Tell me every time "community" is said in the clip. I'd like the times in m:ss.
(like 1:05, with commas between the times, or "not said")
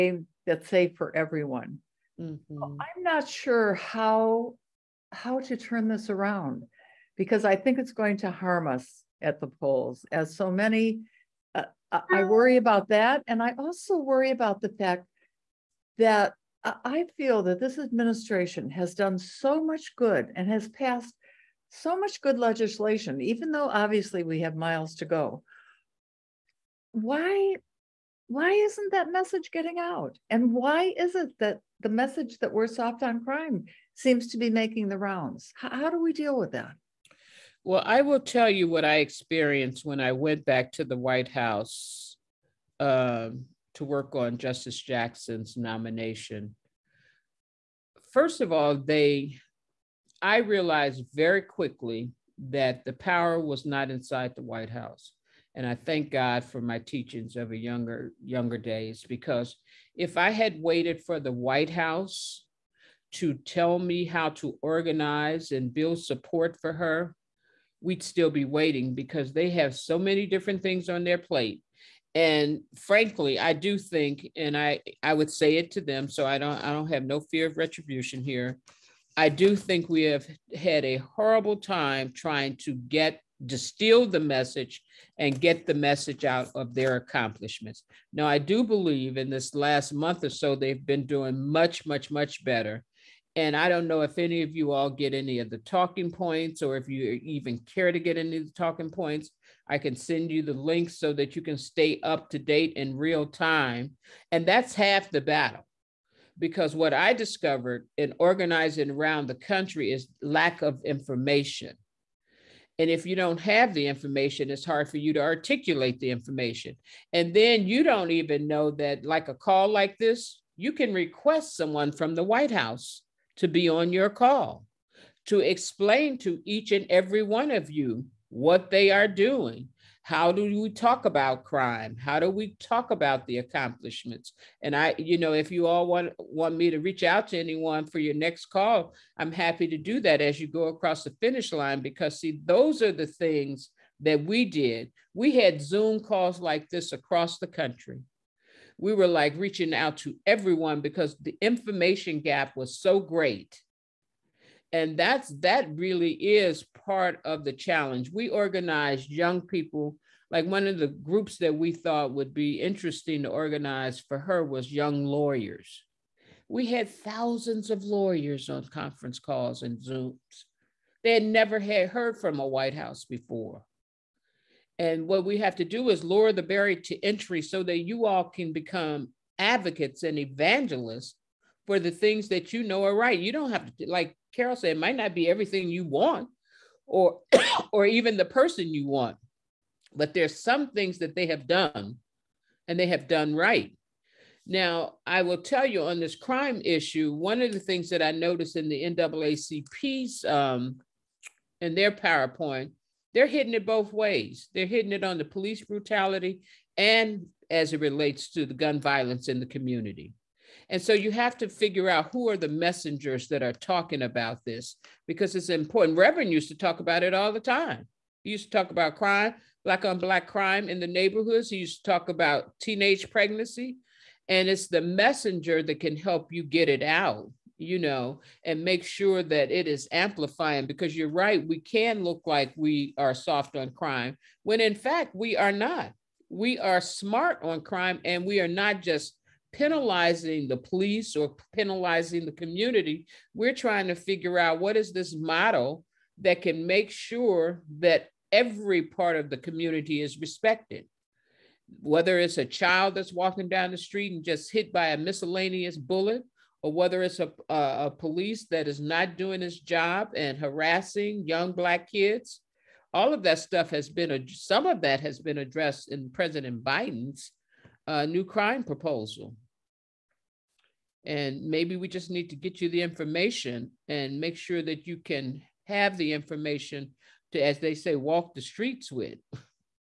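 3:29, 4:02, 4:09.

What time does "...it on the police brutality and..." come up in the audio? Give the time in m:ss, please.
3:24.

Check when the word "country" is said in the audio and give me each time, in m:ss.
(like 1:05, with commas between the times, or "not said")
1:49, 2:27.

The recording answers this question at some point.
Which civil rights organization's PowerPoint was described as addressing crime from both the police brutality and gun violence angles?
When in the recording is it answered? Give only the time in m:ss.
3:18.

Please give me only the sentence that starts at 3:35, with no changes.
Reverend used to talk about it all the time.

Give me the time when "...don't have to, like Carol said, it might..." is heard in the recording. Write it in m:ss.
3:03.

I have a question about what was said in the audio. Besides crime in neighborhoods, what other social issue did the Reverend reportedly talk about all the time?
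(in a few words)
Teenage pregnancy.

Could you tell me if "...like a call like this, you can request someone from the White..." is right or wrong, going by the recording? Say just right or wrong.
right.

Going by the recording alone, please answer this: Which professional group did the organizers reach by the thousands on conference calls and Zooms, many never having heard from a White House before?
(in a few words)
Young lawyers.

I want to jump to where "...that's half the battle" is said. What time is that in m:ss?
1:44.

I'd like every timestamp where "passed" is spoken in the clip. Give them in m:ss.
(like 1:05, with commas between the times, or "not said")
0:20.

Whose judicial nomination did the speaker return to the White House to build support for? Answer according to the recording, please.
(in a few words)
Justice Jackson.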